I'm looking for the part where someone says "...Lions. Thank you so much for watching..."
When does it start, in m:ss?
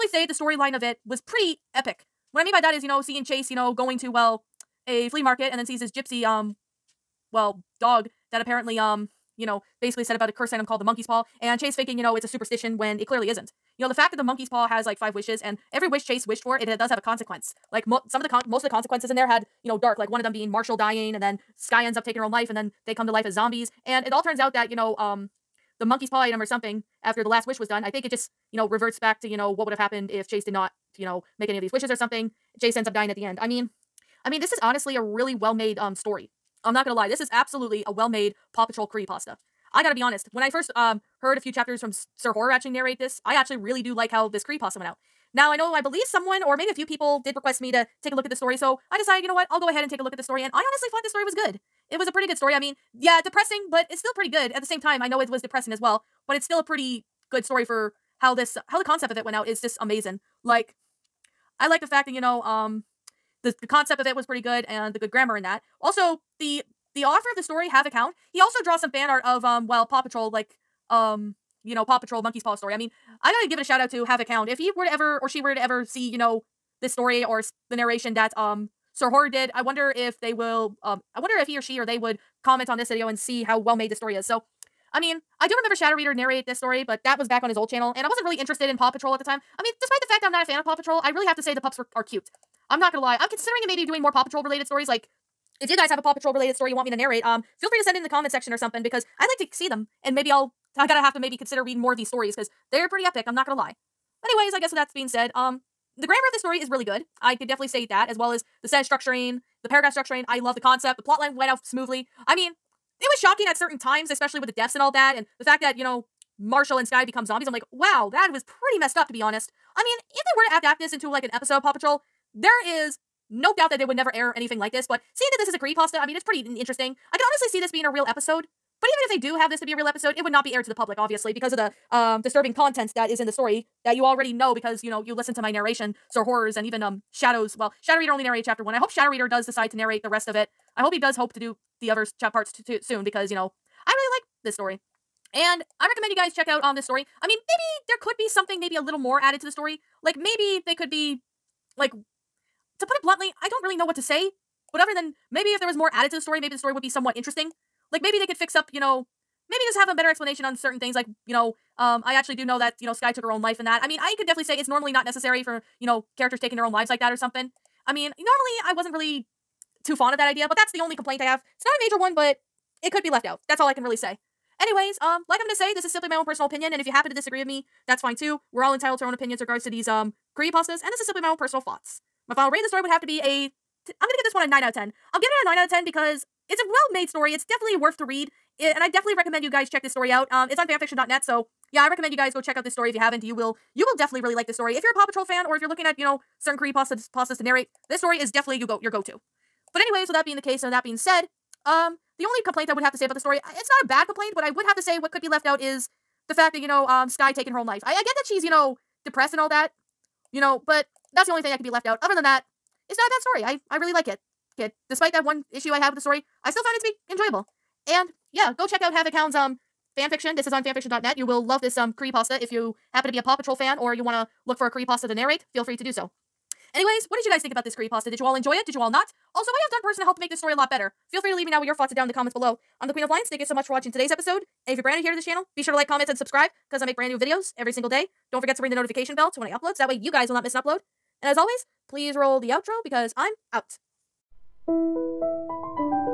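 3:53.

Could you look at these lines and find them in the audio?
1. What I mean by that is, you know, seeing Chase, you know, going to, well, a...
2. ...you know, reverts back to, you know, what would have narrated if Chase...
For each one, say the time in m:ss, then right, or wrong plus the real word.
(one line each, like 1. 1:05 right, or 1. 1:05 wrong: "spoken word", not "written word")
1. 0:02 right
2. 0:28 wrong: "happened", not "narrated".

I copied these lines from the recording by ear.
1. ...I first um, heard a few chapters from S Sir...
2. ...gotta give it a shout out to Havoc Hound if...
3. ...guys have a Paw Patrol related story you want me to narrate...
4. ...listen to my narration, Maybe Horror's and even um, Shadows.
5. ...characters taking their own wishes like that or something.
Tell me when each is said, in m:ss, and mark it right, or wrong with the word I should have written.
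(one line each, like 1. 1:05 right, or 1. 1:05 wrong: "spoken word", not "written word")
1. 0:40 right
2. 1:13 right
3. 1:35 right
4. 2:15 wrong: "Sir", not "Maybe"
5. 2:46 wrong: "lives", not "wishes".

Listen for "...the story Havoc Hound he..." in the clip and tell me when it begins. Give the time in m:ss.
1:07.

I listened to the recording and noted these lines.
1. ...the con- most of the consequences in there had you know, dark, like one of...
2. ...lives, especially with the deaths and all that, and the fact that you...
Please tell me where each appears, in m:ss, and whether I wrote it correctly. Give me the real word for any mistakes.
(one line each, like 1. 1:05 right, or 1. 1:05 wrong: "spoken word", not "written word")
1. 0:18 right
2. 1:53 wrong: "times", not "lives".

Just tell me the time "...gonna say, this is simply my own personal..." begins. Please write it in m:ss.
2:55.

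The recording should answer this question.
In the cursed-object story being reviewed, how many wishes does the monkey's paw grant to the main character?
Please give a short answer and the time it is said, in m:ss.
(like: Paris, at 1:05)
5, at 0:14.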